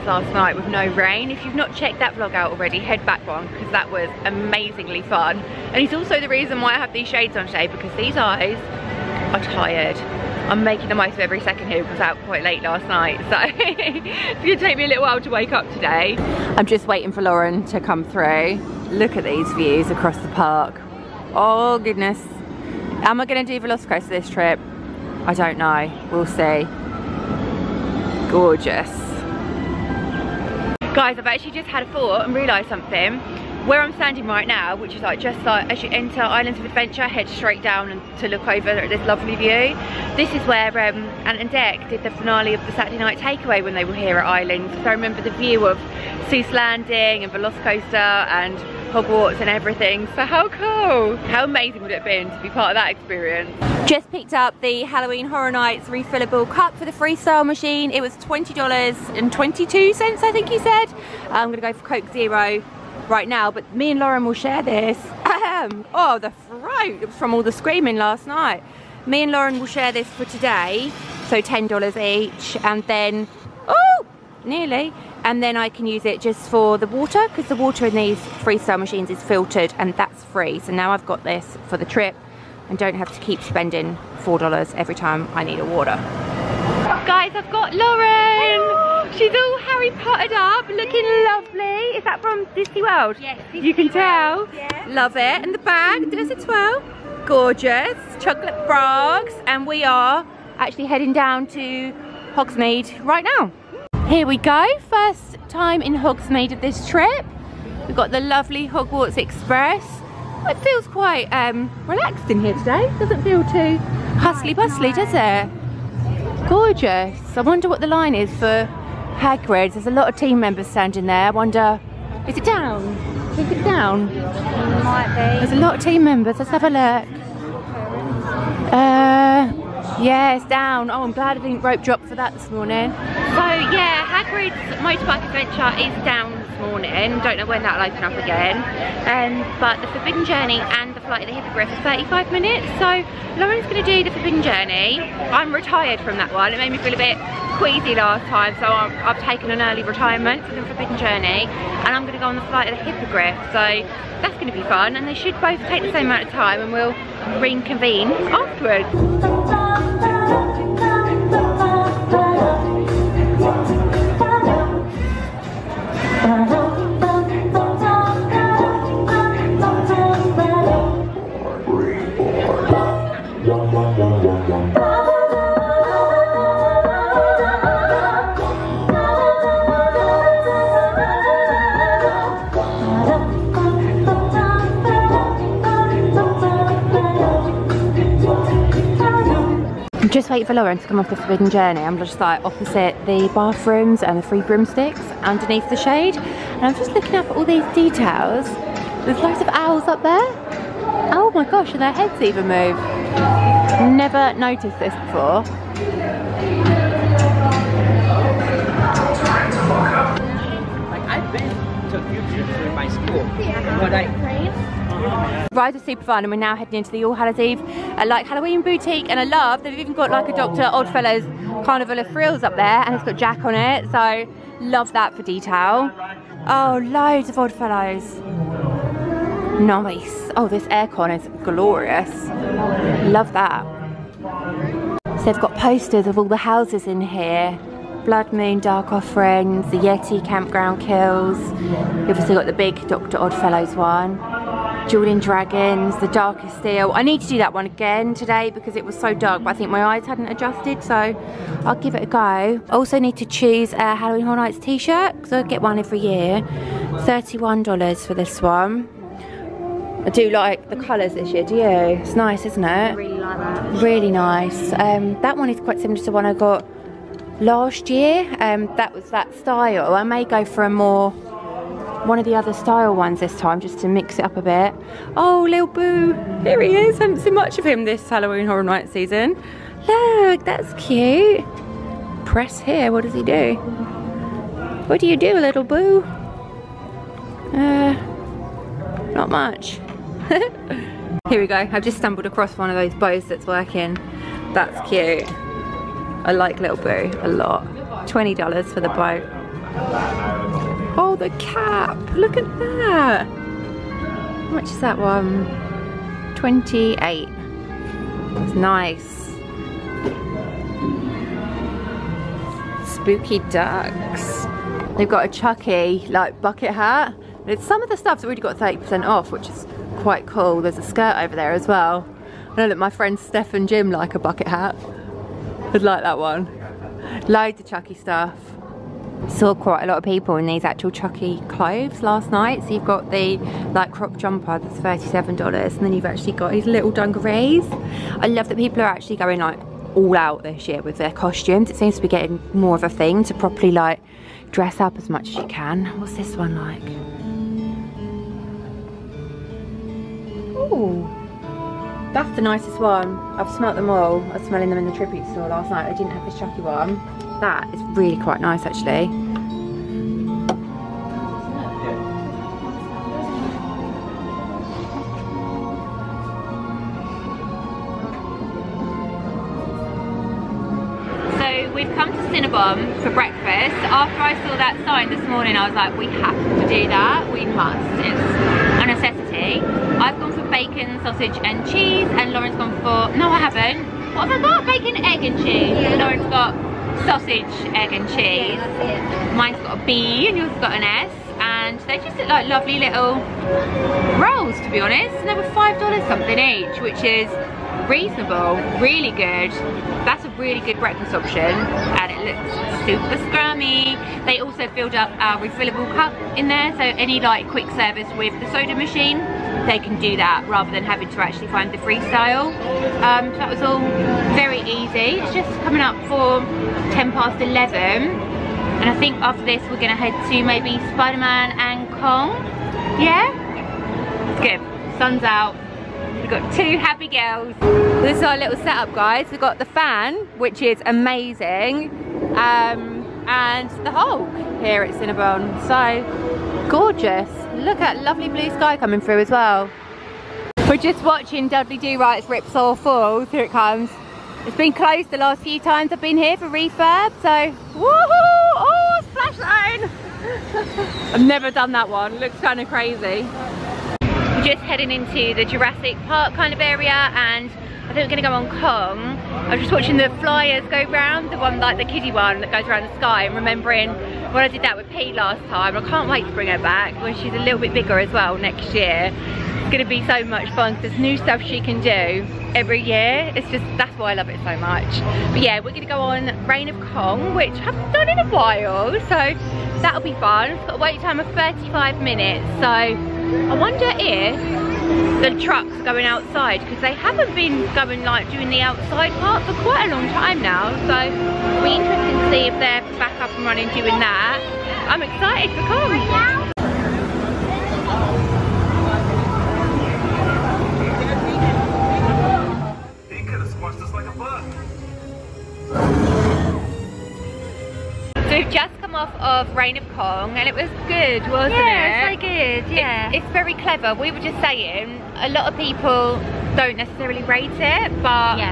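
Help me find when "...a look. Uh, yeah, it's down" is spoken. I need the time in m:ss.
2:06.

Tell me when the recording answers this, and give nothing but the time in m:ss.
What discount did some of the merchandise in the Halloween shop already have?
5:18.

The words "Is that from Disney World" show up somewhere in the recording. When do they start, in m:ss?
1:31.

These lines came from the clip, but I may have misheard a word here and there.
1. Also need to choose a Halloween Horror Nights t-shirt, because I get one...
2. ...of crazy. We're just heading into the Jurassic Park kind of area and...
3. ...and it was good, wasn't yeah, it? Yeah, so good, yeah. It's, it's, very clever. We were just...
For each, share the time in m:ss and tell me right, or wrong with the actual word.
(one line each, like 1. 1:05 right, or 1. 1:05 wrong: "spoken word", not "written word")
1. 4:12 right
2. 7:32 right
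3. 8:30 right.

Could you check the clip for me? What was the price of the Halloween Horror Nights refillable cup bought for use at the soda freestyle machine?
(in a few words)
$20.22.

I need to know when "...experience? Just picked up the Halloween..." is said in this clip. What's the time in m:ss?
0:52.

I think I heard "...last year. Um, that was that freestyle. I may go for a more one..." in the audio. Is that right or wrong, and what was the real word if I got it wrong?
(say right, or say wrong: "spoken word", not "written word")
wrong: "style", not "freestyle".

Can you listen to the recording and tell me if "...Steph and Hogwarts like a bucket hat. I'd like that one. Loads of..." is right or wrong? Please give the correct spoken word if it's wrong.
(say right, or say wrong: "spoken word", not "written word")
wrong: "Jim", not "Hogwarts".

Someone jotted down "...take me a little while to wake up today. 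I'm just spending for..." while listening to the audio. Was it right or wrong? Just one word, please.
wrong.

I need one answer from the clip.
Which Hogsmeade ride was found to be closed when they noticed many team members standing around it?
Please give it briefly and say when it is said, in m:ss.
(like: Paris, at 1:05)
Hagrid's motorbike adventure, at 2:14.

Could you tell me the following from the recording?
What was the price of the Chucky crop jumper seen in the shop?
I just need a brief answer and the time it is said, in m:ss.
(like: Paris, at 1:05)
$37, at 5:34.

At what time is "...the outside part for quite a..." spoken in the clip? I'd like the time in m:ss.
8:08.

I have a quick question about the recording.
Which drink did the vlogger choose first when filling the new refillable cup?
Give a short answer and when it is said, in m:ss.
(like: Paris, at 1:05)
Coke Zero, at 1:01.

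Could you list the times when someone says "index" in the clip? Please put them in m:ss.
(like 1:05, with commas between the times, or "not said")
not said.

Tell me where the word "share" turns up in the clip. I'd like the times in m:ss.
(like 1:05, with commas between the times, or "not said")
1:04, 1:09.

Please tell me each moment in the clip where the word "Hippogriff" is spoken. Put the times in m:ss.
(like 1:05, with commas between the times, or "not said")
2:21, 2:32.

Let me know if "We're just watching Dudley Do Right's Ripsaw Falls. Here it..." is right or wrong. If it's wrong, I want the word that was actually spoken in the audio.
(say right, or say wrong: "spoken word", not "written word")
right.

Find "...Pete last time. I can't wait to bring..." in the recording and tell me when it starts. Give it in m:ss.
7:44.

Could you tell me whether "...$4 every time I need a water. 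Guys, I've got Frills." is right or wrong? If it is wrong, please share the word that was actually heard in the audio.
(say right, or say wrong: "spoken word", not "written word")
wrong: "Lauren", not "Frills".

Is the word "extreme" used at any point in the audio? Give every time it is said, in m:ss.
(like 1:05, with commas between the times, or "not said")
not said.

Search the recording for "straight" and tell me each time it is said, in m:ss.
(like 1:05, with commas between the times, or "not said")
0:37.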